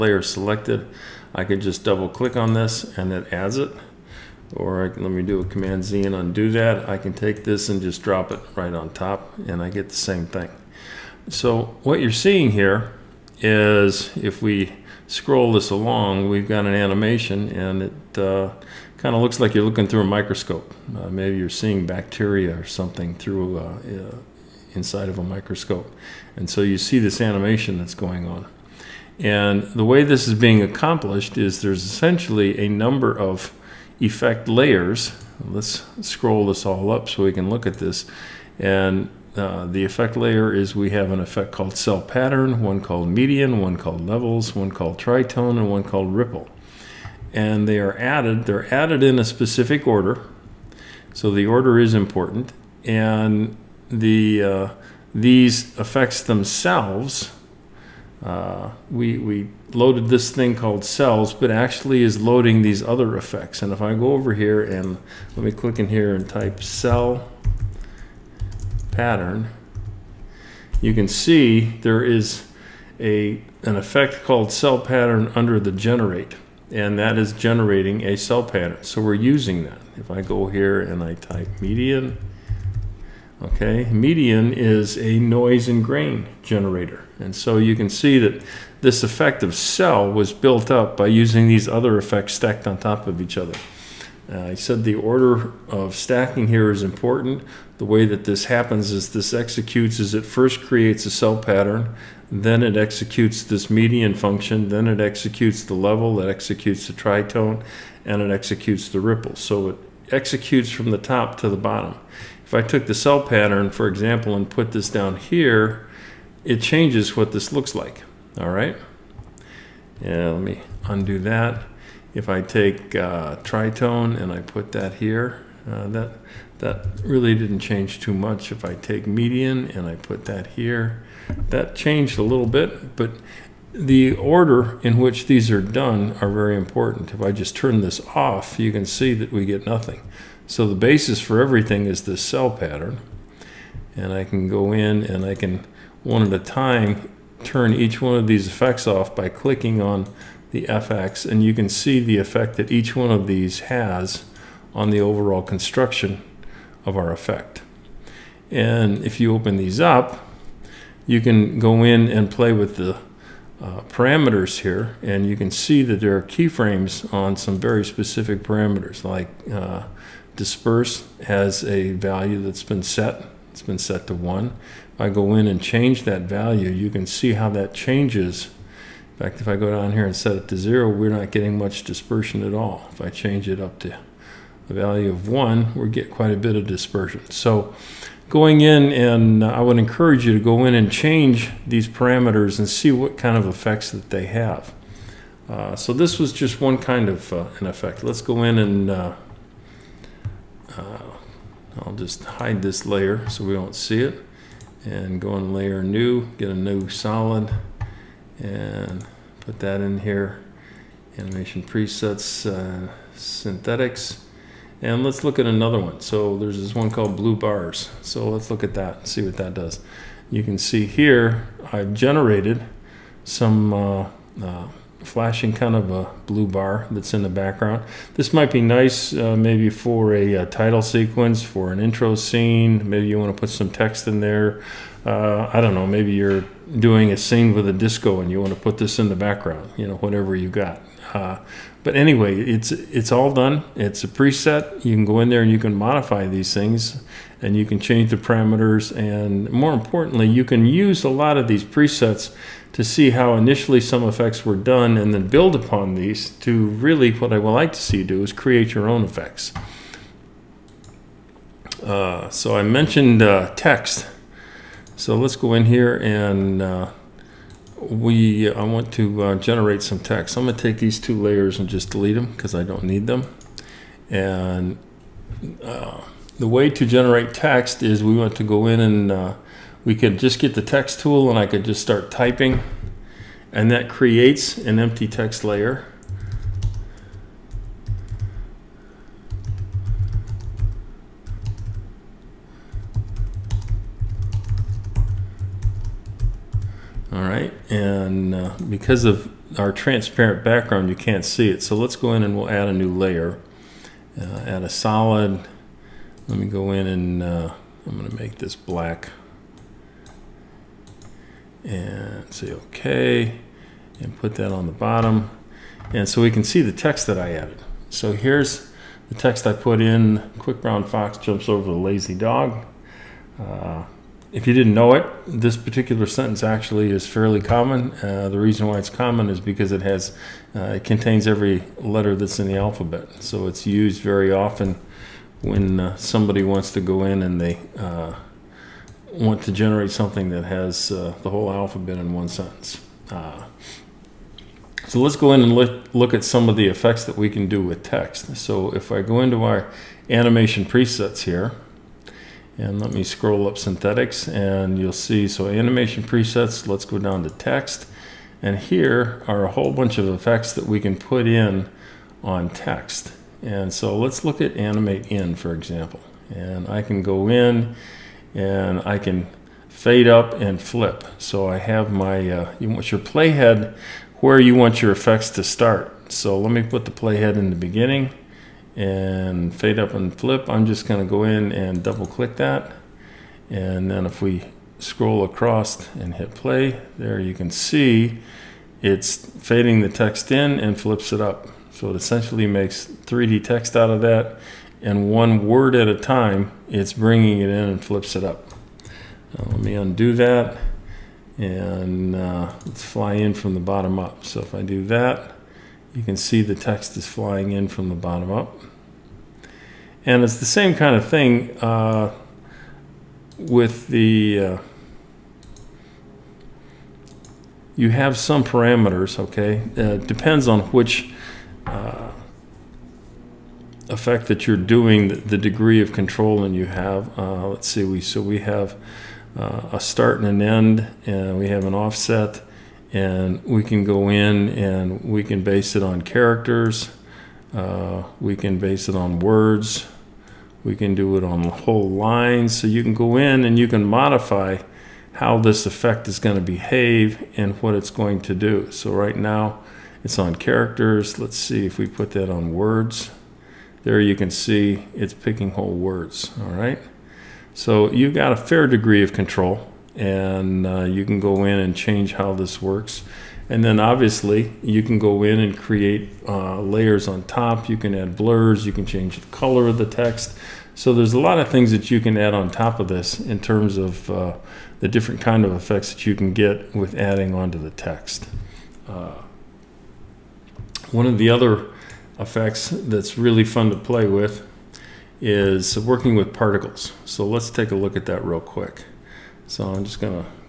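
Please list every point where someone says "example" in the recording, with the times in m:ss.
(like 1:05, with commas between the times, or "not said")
1:53, 6:05.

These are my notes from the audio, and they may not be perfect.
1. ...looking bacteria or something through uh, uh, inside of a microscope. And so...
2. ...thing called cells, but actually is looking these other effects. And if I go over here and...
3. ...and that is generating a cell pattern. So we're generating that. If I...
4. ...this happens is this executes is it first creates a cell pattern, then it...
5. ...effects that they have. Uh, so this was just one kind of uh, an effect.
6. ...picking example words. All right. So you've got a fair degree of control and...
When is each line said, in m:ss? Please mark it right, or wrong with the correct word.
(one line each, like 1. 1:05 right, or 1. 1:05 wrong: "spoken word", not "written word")
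1. 0:21 wrong: "seeing", not "looking"
2. 1:00 wrong: "loading", not "looking"
3. 1:16 wrong: "using", not "generating"
4. 1:38 right
5. 3:13 right
6. 7:35 wrong: "whole", not "example".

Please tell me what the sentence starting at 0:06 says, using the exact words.
I can take this and just drop it right on top and I get the same thing.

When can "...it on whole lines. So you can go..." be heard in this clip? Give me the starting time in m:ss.
7:21.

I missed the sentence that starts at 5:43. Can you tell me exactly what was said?
Uh, so let's go in and look, look at some of the effects that we can do with text.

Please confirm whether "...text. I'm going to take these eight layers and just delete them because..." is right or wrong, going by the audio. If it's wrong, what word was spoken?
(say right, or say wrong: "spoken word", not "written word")
wrong: "two", not "eight".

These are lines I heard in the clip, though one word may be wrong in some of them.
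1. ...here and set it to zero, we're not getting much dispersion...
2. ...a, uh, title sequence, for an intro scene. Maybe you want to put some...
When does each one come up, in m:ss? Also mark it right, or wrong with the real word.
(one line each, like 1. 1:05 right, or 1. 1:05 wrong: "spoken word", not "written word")
1. 2:59 right
2. 3:50 right.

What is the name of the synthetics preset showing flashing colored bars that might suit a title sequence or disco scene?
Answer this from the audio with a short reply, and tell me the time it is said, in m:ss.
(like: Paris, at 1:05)
blue bars, at 3:36.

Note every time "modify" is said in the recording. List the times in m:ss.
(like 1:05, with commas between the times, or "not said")
4:05, 7:23.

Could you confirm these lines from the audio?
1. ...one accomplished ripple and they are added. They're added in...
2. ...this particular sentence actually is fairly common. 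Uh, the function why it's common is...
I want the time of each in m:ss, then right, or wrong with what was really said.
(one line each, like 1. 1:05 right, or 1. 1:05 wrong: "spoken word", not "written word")
1. 0:45 wrong: "called", not "accomplished"
2. 5:25 wrong: "reason", not "function".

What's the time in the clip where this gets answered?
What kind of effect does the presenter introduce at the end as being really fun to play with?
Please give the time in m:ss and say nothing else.
8:05.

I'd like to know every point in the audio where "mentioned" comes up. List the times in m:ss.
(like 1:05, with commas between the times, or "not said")
4:22.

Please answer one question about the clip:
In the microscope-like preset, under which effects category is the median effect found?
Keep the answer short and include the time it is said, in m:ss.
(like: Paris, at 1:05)
noise and grain, at 1:23.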